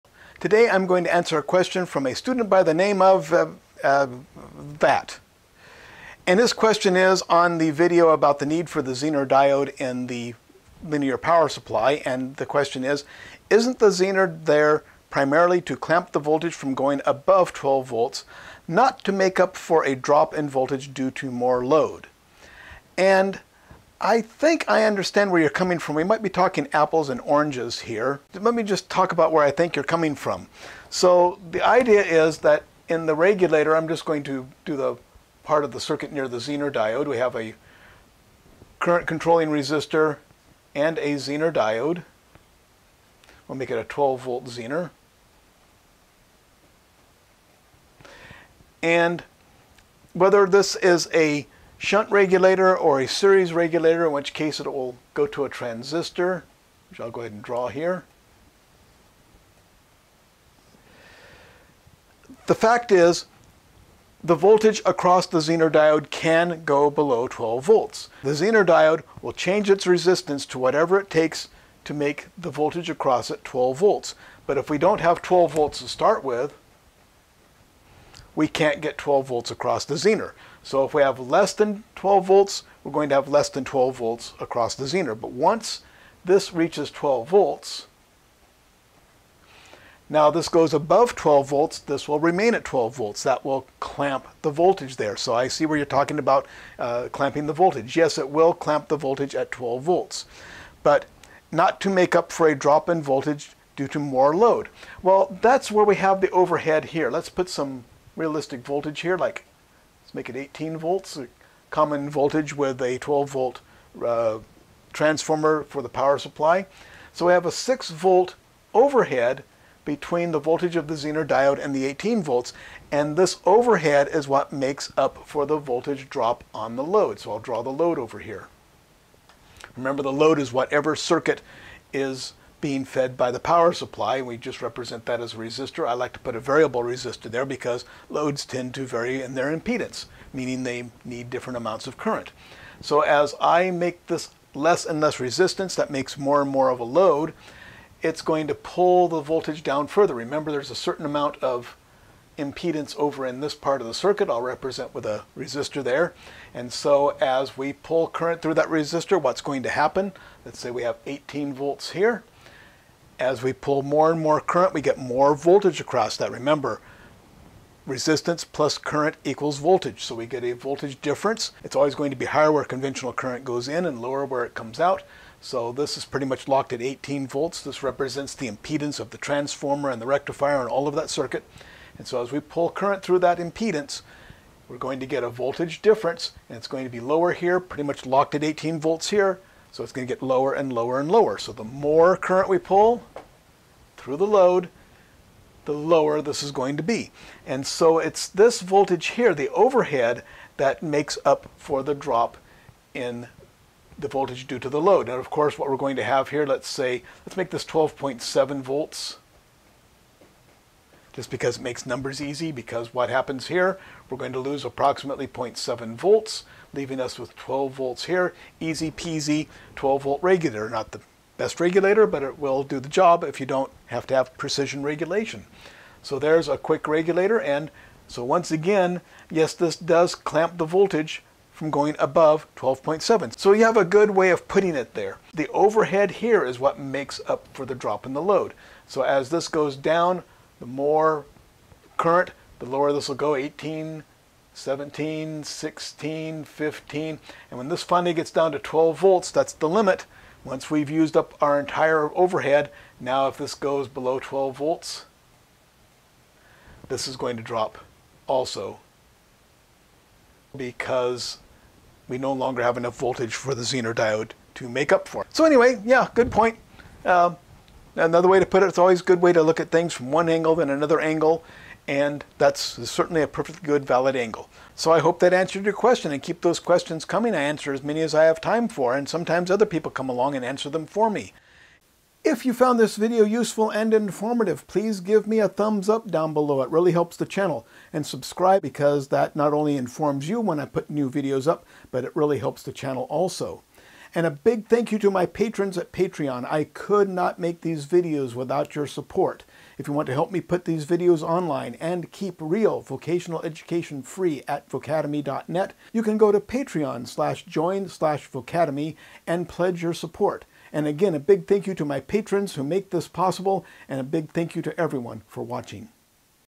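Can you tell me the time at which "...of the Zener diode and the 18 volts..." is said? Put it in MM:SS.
02:00.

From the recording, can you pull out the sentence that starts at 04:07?
And when this finally gets down to 12 volts, that's the limit.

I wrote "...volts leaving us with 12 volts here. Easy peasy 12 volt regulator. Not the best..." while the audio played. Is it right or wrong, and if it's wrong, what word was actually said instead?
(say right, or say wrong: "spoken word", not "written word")
right.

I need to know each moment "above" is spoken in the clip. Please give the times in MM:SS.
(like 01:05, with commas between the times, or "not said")
00:17, 01:30, 03:51.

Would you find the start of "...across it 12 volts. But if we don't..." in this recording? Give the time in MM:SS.
01:12.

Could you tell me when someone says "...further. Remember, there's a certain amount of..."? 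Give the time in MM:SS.
02:29.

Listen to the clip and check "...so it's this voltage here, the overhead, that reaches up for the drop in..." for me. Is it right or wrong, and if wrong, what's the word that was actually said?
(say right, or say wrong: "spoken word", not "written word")
wrong: "makes", not "reaches".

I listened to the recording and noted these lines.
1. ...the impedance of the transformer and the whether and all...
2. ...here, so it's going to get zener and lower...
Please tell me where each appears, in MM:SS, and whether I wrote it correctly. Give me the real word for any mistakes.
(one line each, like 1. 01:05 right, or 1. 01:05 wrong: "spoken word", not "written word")
1. 02:58 wrong: "rectifier", not "whether"
2. 03:09 wrong: "lower", not "zener".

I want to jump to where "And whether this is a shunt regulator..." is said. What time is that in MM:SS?
00:48.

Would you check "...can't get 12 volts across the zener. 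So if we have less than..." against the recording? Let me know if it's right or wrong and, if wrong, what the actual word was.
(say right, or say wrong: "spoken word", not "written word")
right.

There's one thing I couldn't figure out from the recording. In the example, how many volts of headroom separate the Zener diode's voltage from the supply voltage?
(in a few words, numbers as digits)
6 volt.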